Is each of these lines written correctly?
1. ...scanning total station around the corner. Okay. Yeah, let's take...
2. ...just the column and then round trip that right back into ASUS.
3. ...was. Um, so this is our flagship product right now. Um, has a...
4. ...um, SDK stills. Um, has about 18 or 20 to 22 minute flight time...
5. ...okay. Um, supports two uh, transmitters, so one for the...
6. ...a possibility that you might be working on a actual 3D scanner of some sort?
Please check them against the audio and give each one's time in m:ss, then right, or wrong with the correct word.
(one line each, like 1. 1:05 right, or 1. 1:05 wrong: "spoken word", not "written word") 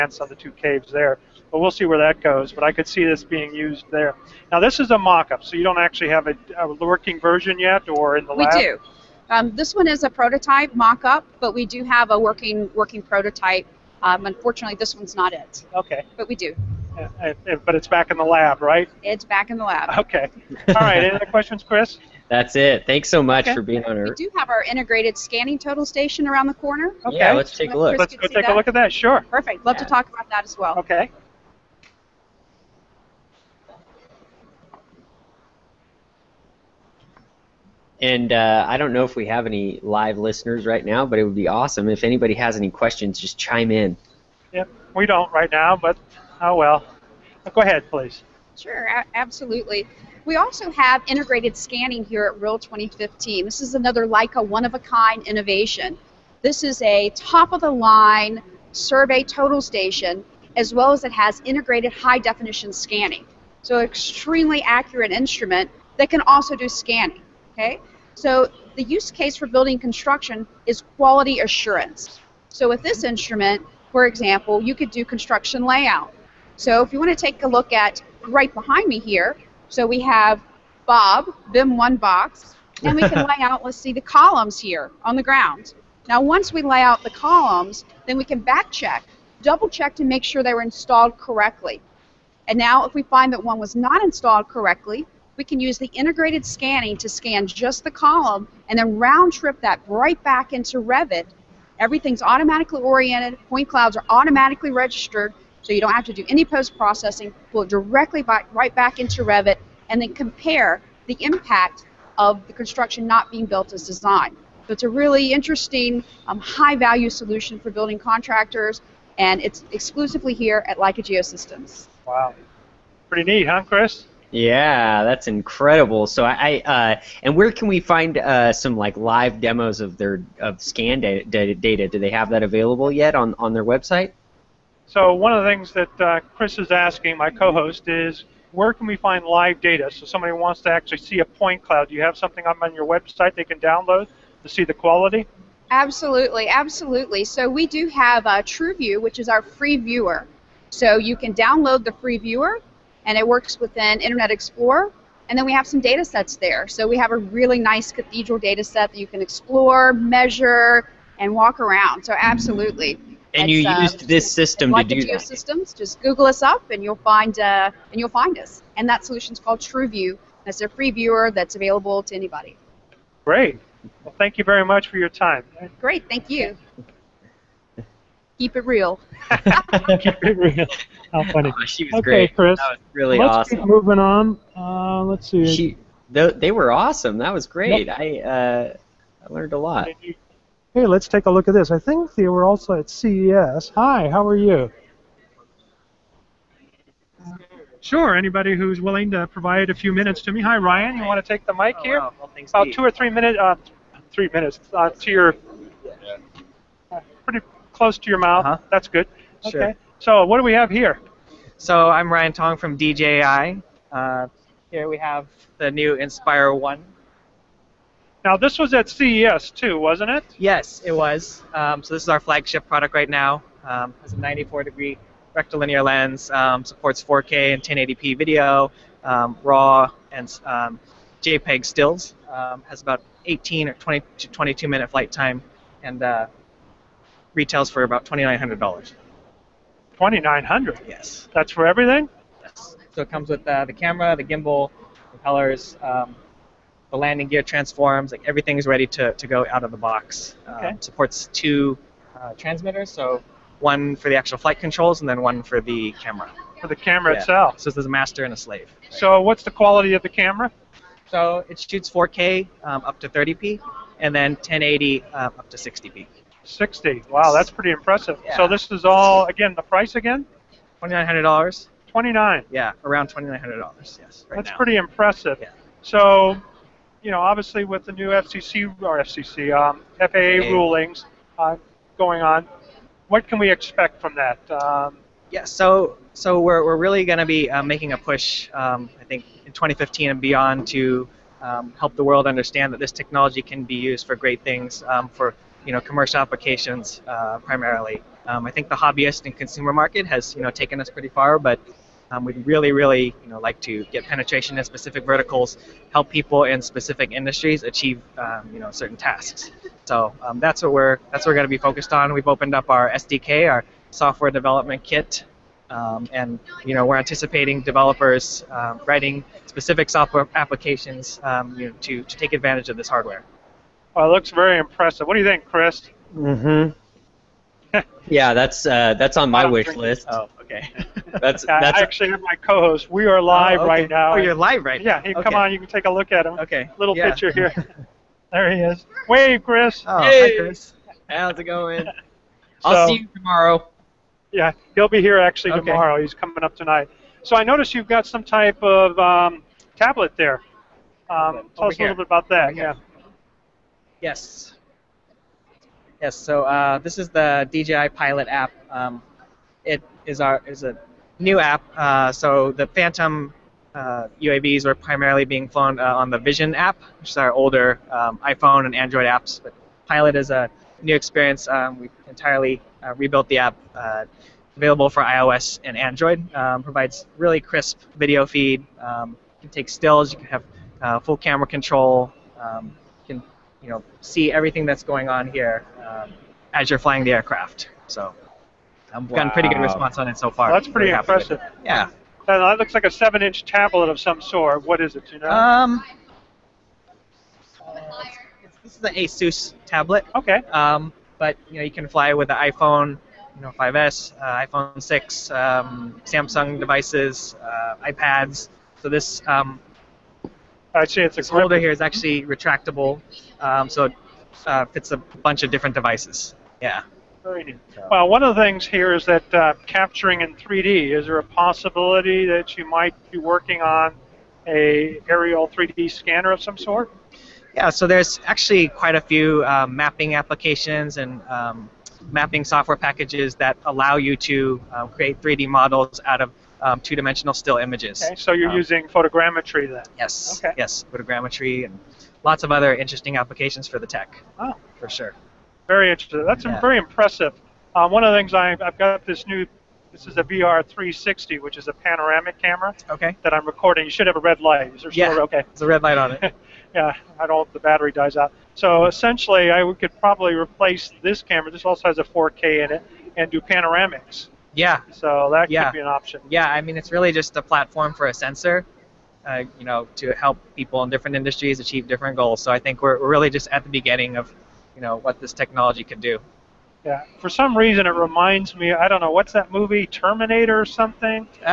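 1. 0:25 right
2. 1:37 wrong: "Revit", not "ASUS"
3. 3:40 right
4. 3:50 wrong: "JPEG", not "SDK"
5. 4:10 right
6. 7:01 wrong: "aerial", not "actual".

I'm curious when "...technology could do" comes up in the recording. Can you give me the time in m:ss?
7:55.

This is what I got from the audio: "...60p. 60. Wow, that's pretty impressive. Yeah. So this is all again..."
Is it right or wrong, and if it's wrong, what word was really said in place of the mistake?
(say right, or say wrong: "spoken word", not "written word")
right.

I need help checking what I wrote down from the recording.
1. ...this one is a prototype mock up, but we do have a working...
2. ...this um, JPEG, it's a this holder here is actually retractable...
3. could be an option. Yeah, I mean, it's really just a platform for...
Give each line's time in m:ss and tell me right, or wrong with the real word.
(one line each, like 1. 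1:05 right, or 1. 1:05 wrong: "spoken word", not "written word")
1. 0:09 right
2. 6:48 wrong: "Actually", not "JPEG"
3. 7:45 right.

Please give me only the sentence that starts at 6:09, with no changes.
But Pilot is a new experience.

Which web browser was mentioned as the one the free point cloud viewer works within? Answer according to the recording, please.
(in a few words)
Internet Explorer.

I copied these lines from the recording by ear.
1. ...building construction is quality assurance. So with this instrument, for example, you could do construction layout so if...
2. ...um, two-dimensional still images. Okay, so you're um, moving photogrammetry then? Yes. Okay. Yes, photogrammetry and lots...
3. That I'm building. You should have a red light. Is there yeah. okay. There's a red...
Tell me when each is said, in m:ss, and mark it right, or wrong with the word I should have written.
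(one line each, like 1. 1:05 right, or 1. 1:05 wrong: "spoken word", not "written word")
1. 1:09 right
2. 7:16 wrong: "using", not "moving"
3. 7:33 wrong: "recording", not "building".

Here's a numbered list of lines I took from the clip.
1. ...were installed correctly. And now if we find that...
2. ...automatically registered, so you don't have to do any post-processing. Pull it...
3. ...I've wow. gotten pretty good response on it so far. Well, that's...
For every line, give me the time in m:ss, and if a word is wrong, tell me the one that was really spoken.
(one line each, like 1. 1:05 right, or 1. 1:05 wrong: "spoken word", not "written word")
1. 1:30 right
2. 1:44 right
3. 6:28 right.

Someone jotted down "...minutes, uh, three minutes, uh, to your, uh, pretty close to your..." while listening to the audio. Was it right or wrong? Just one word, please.
right.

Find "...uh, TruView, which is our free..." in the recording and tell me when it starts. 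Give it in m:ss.
2:28.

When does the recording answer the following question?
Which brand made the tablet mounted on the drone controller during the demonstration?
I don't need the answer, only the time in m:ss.
6:38.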